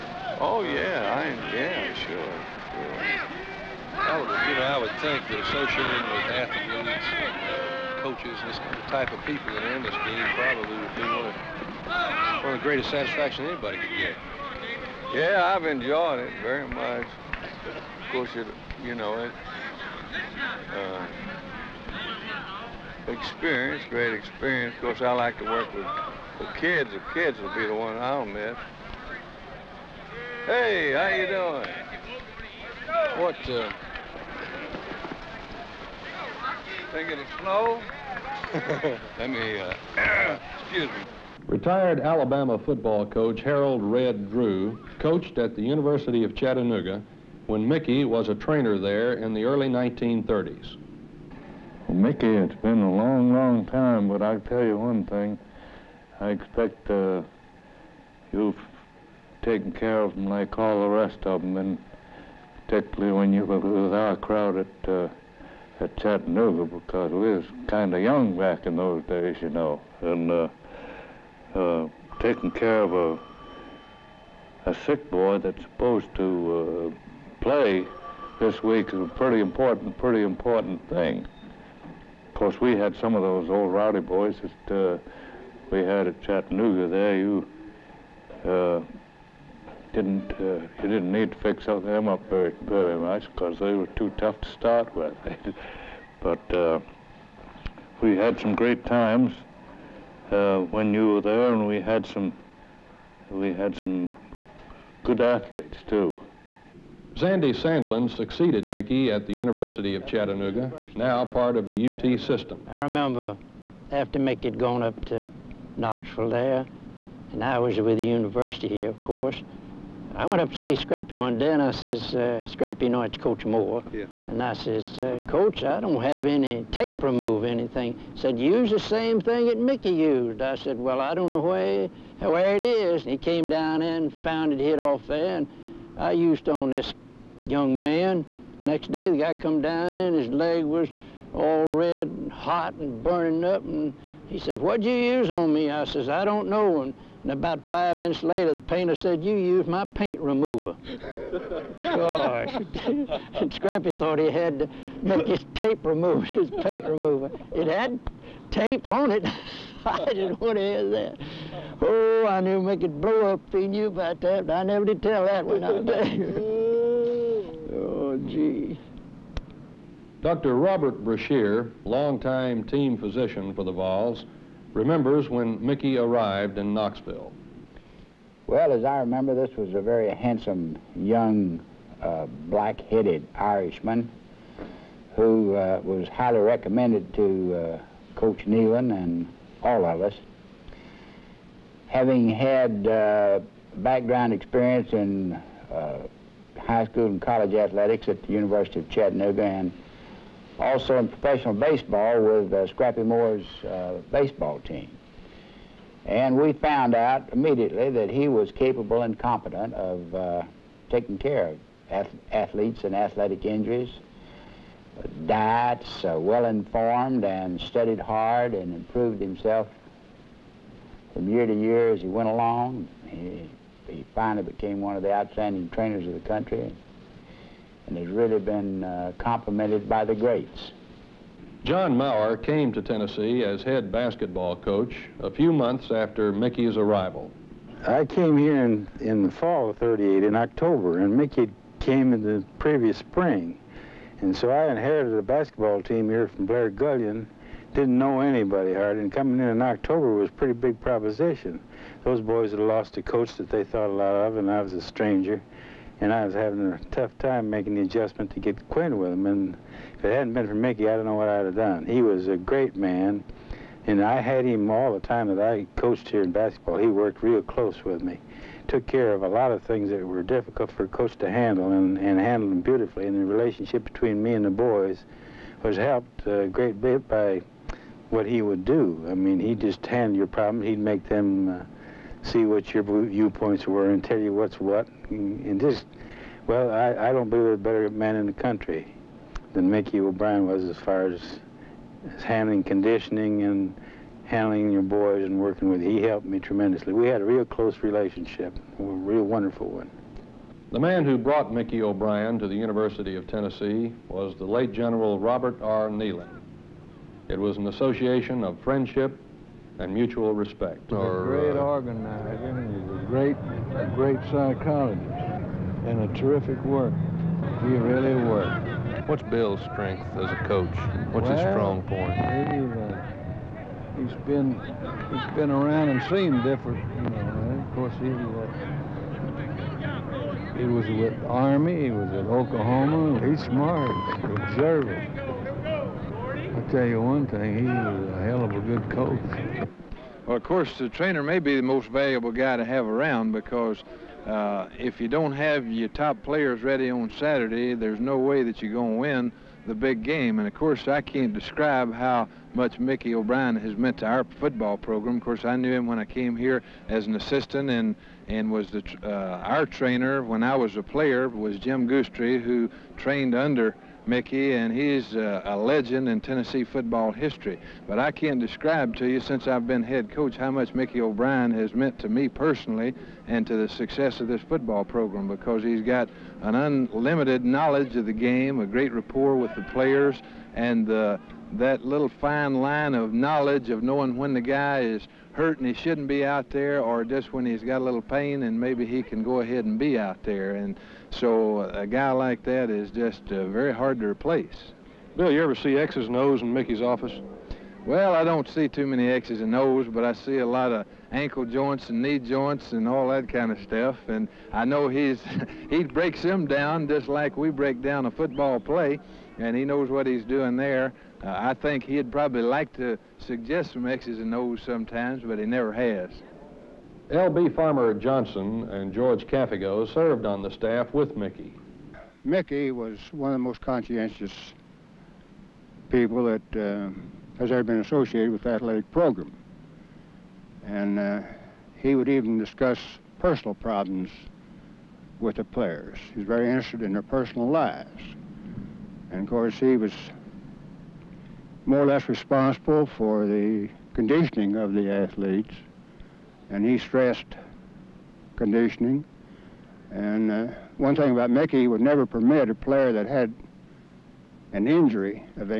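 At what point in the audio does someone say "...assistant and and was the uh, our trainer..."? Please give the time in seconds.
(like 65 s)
357 s.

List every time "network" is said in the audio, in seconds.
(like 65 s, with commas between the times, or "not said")
not said.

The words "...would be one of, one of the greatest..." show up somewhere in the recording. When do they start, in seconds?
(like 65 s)
10 s.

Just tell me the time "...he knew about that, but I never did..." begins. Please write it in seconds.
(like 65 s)
163 s.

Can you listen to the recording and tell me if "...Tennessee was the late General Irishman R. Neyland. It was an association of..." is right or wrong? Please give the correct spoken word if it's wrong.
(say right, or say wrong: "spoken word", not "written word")
wrong: "Robert", not "Irishman".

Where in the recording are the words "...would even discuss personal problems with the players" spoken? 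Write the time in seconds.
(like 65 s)
431 s.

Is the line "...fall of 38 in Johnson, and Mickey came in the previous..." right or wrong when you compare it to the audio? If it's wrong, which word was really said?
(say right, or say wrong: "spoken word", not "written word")
wrong: "October", not "Johnson".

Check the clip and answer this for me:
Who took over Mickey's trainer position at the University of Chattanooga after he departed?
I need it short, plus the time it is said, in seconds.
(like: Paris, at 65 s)
Sandy Sandlin, at 107 s.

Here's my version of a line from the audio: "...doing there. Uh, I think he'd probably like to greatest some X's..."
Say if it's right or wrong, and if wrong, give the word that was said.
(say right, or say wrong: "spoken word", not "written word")
wrong: "suggest", not "greatest".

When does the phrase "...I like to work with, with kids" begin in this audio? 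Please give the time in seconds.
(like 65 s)
25 s.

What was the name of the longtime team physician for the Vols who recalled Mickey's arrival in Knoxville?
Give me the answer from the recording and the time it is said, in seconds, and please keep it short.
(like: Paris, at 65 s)
Robert Brashear, at 170 s.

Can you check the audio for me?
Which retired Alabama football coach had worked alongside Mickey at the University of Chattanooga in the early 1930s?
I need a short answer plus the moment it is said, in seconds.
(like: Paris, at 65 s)
Harold Red Drew, at 43 s.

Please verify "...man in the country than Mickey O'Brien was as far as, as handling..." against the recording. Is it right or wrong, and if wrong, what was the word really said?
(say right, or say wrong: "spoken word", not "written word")
right.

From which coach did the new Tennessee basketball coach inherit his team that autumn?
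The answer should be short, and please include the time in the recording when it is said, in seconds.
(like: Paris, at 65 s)
Blair Gullion, at 246 s.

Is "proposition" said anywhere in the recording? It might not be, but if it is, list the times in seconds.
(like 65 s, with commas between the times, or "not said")
250 s.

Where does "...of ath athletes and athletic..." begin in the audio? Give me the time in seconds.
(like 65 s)
211 s.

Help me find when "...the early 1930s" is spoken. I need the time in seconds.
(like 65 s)
49 s.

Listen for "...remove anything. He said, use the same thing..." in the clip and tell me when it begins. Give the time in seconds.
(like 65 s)
127 s.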